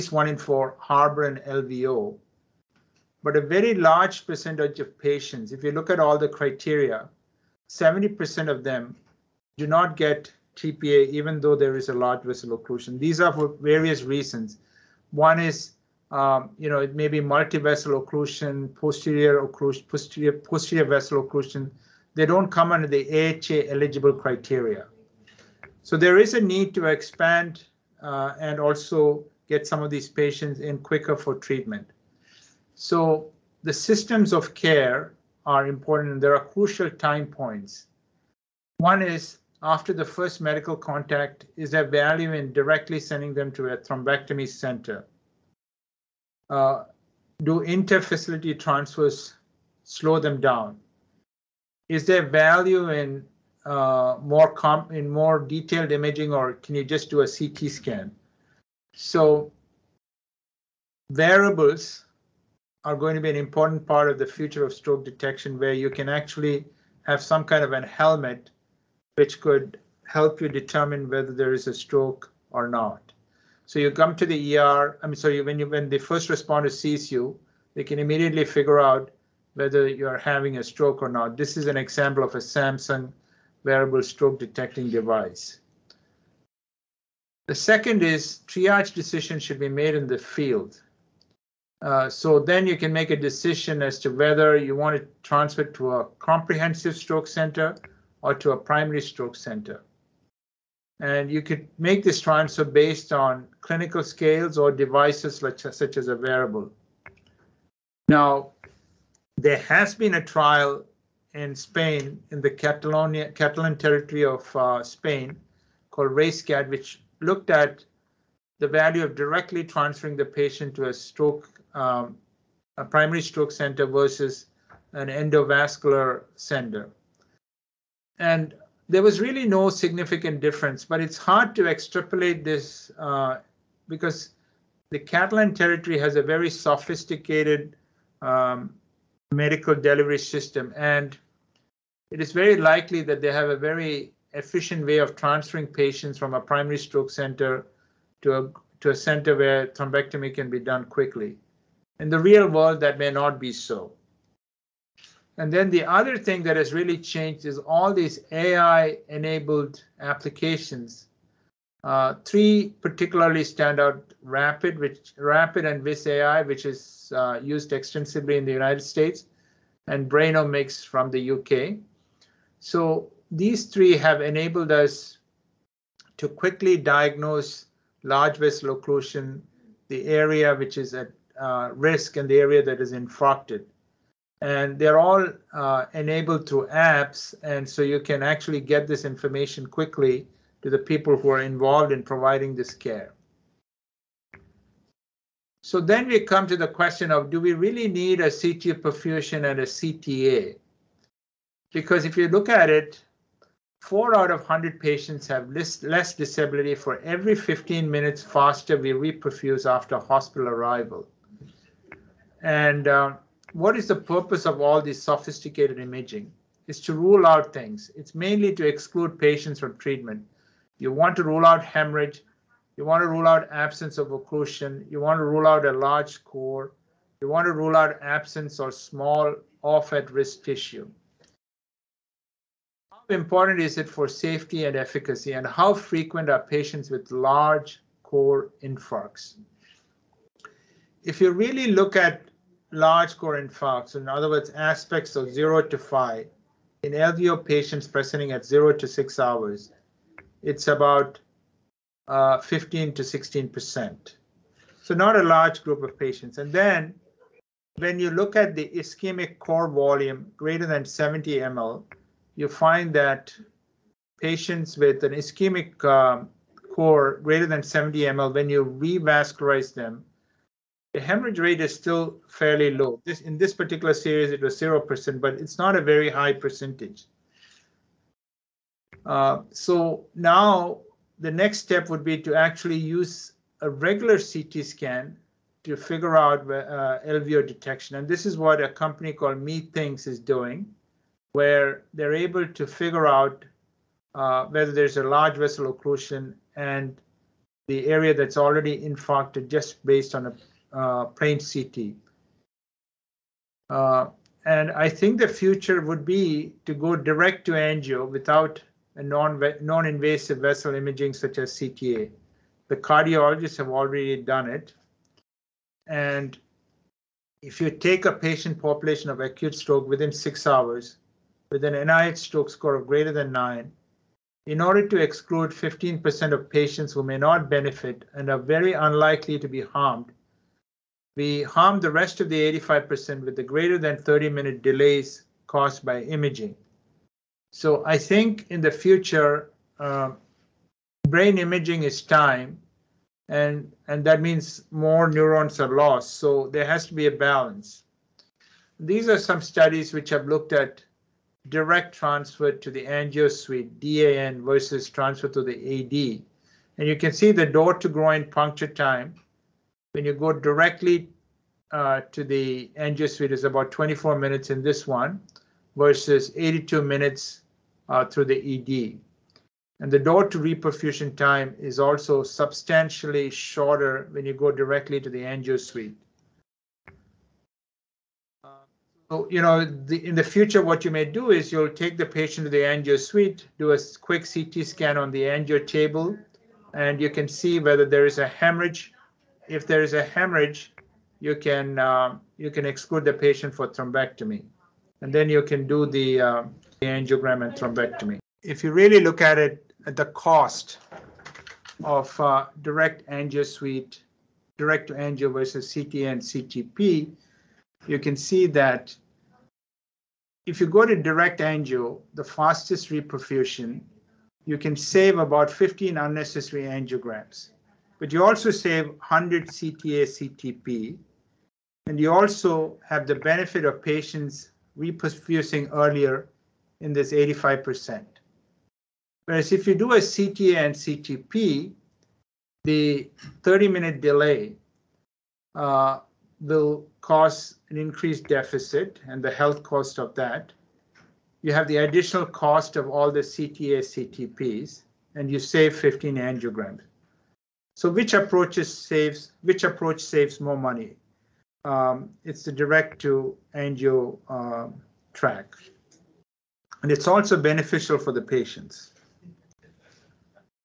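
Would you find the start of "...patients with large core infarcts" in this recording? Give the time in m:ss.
3:56.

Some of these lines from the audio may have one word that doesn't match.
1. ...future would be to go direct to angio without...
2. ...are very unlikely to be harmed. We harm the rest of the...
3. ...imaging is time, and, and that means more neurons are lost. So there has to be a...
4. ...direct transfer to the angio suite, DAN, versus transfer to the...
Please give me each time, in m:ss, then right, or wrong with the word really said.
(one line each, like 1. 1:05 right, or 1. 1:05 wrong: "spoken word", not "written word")
1. 5:05 right
2. 5:28 right
3. 5:41 right
4. 5:51 right.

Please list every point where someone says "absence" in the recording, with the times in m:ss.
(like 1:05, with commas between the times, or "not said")
3:43, 3:48.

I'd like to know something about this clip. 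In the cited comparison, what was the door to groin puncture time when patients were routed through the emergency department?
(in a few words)
82 minutes.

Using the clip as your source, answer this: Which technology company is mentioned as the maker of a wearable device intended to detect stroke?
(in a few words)
Samsung.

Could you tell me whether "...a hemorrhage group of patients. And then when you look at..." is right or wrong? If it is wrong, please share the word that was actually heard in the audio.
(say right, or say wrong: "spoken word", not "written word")
wrong: "large", not "hemorrhage".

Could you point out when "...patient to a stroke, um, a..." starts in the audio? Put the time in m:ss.
2:00.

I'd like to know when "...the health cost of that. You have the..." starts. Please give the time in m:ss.
7:19.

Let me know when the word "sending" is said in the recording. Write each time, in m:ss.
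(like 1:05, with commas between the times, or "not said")
0:42.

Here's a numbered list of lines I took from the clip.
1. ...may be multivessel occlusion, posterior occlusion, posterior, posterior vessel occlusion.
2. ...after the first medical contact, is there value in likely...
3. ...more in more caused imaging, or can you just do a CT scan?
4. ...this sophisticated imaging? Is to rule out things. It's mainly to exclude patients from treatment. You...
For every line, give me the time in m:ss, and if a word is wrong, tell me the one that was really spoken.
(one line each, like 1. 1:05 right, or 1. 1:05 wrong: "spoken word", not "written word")
1. 0:16 right
2. 0:39 wrong: "directly", not "likely"
3. 0:54 wrong: "detailed", not "caused"
4. 3:34 right.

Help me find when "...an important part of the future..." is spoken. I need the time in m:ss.
1:03.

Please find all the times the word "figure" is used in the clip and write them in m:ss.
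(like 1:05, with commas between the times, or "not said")
1:18, 4:45, 4:52.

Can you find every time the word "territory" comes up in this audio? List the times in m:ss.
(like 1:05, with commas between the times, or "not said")
1:53, 2:15.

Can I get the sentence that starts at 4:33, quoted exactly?
This, in this particular series, it was 0%, but it's not a very high percentage.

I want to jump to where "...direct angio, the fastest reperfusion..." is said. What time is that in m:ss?
6:50.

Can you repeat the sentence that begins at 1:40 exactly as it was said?
And you could make this transfer based on clinical scales or devices like, such as a wearable.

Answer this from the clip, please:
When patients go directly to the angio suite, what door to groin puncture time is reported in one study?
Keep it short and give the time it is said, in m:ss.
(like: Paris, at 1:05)
24 minutes, at 6:03.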